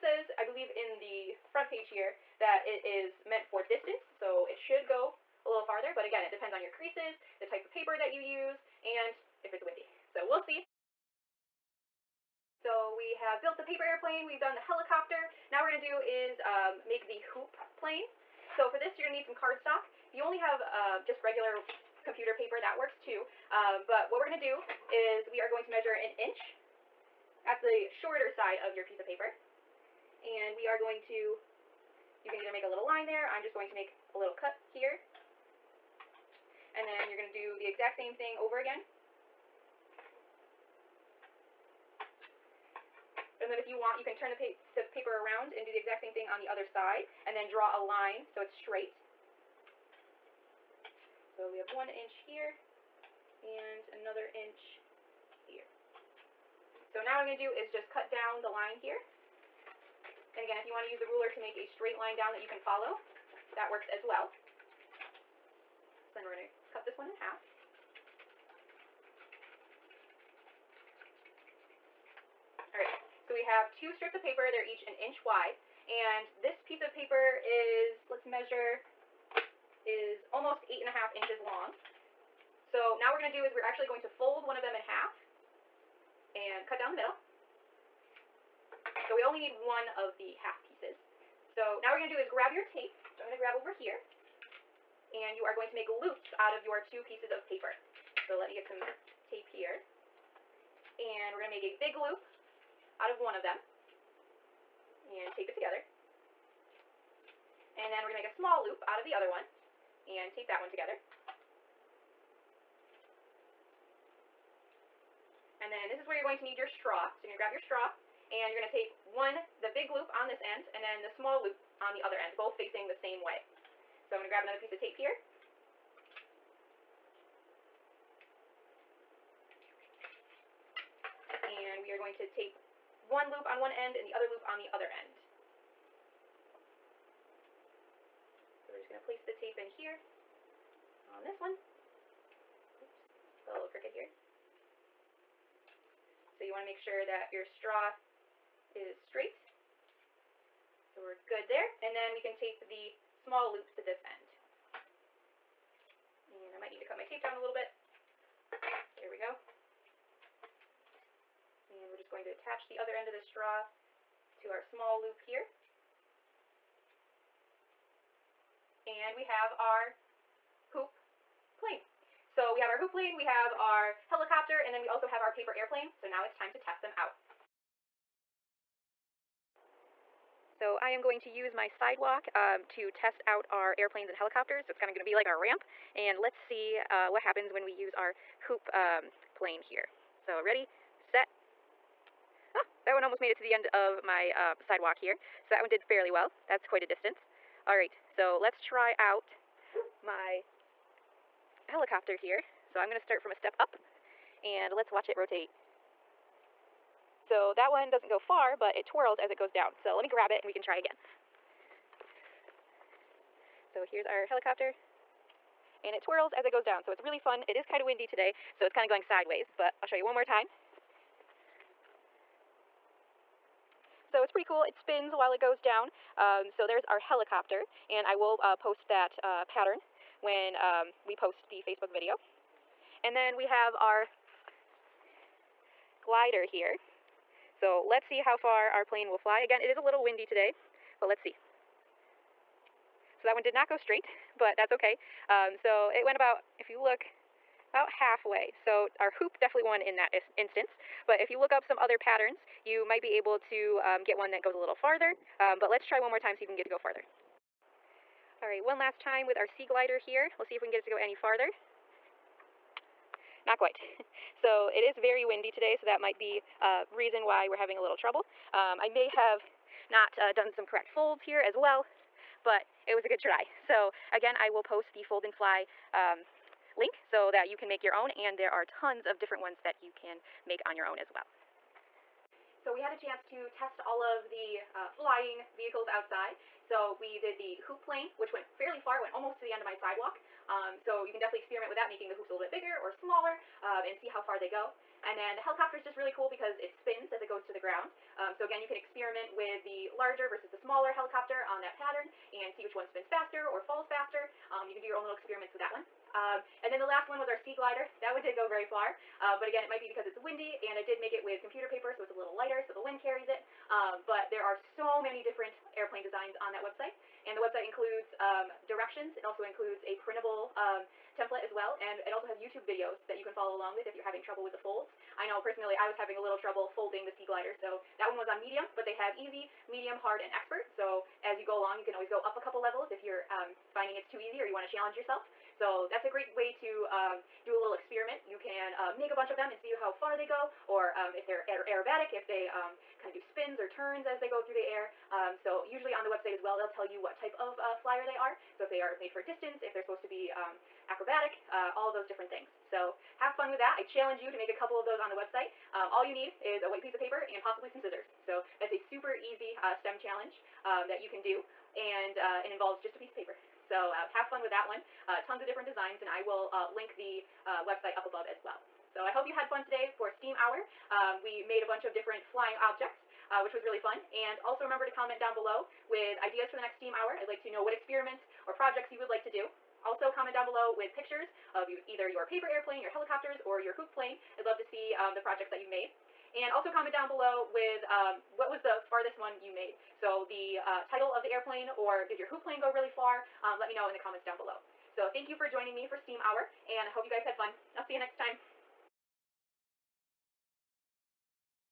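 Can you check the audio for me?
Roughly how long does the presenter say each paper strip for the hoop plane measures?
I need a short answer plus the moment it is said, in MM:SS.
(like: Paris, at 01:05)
almost 8 and a half inches, at 01:20.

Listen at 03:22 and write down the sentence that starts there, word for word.
So I'm gonna start from a step up and let's watch it rotate.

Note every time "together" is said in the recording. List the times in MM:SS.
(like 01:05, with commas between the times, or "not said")
01:45, 01:50.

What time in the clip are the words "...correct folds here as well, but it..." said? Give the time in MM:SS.
04:30.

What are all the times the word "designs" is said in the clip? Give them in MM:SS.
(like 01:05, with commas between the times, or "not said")
05:16, 06:05.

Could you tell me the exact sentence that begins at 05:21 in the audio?
And it also has YouTube videos that you can follow along with if you're having trouble with the folds.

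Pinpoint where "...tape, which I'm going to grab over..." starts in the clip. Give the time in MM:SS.
01:32.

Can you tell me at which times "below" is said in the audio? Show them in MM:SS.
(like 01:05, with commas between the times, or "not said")
06:15, 06:20, 06:27, 06:34.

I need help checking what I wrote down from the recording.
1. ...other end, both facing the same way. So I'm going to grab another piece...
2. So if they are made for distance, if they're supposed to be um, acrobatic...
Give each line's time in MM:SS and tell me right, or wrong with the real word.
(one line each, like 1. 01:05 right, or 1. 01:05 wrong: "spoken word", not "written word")
1. 02:02 right
2. 05:48 right.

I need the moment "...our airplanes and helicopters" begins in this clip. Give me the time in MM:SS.
03:03.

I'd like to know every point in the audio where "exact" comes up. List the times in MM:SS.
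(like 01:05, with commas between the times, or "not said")
00:37, 00:45.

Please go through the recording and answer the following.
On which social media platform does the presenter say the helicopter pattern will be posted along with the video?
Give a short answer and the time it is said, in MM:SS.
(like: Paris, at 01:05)
Facebook, at 03:51.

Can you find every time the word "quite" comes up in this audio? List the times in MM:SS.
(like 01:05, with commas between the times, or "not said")
03:16, 04:23.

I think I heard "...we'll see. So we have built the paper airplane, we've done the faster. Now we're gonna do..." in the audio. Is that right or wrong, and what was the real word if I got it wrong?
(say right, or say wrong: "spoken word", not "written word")
wrong: "helicopter", not "faster".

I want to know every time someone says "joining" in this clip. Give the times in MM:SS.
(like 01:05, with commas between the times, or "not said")
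06:35.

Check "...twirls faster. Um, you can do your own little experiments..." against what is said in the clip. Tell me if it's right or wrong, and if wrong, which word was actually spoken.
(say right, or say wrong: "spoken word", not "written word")
wrong: "falls", not "twirls".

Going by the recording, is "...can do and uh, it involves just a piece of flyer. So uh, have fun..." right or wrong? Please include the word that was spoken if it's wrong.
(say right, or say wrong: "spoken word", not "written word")
wrong: "paper", not "flyer".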